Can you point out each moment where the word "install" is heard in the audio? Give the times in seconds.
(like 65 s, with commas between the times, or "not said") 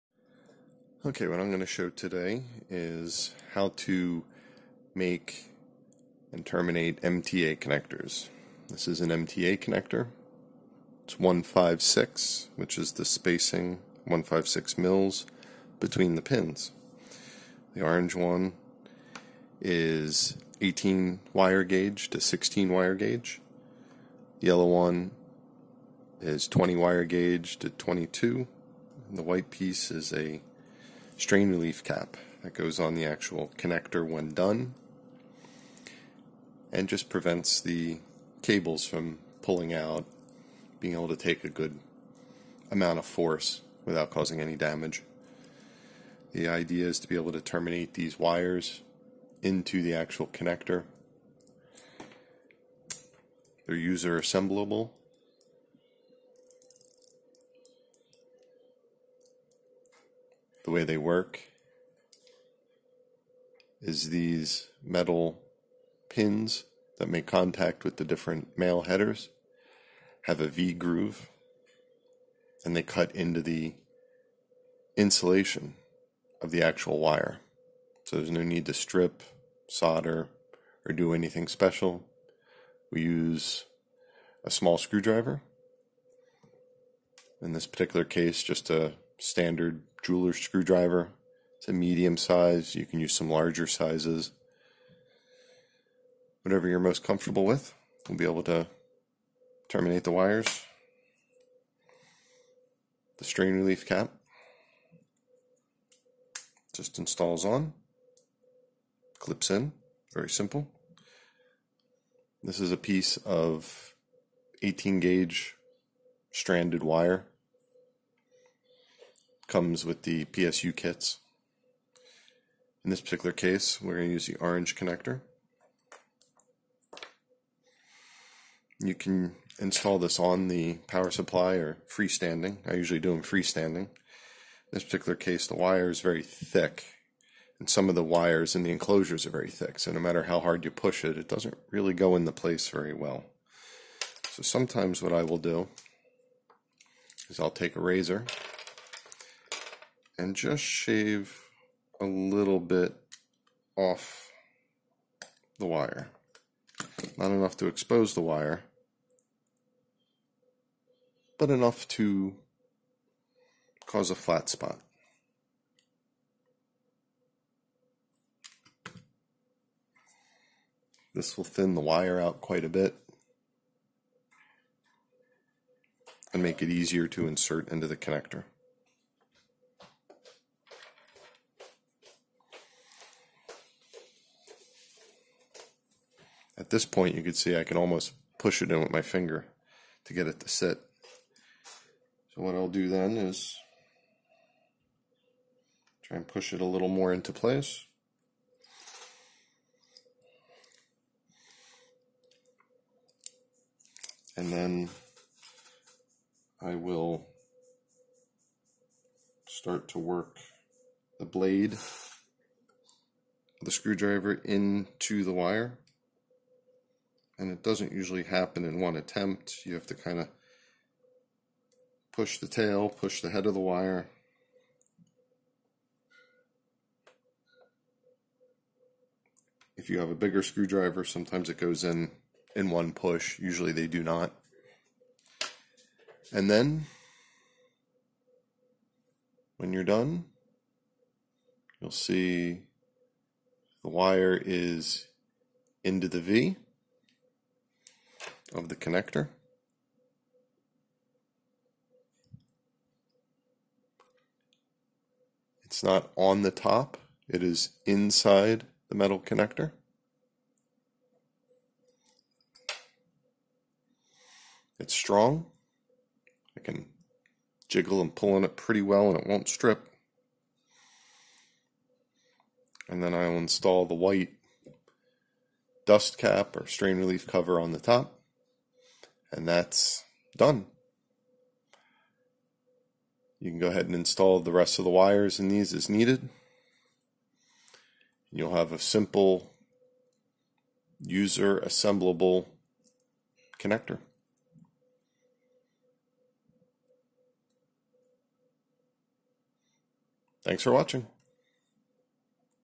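106 s, 129 s, 273 s, 283 s.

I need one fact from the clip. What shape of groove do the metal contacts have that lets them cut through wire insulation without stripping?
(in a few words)
V groove.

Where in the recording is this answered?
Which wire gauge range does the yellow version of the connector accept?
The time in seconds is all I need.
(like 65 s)
26 s.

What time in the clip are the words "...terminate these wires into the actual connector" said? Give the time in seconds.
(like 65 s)
47 s.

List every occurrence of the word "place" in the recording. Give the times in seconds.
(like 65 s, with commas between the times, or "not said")
142 s, 197 s.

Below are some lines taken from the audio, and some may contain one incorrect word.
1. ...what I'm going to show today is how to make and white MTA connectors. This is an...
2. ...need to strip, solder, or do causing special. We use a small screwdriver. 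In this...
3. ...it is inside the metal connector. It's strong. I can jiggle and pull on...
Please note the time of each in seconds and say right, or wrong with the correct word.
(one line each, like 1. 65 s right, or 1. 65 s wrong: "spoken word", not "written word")
1. 1 s wrong: "terminate", not "white"
2. 78 s wrong: "anything", not "causing"
3. 257 s right.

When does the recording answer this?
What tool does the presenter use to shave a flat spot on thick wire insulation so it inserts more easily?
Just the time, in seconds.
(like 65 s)
147 s.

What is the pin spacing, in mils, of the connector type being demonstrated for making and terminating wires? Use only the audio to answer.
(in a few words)
156.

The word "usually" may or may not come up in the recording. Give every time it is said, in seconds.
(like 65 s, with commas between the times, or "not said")
132 s, 217 s, 233 s.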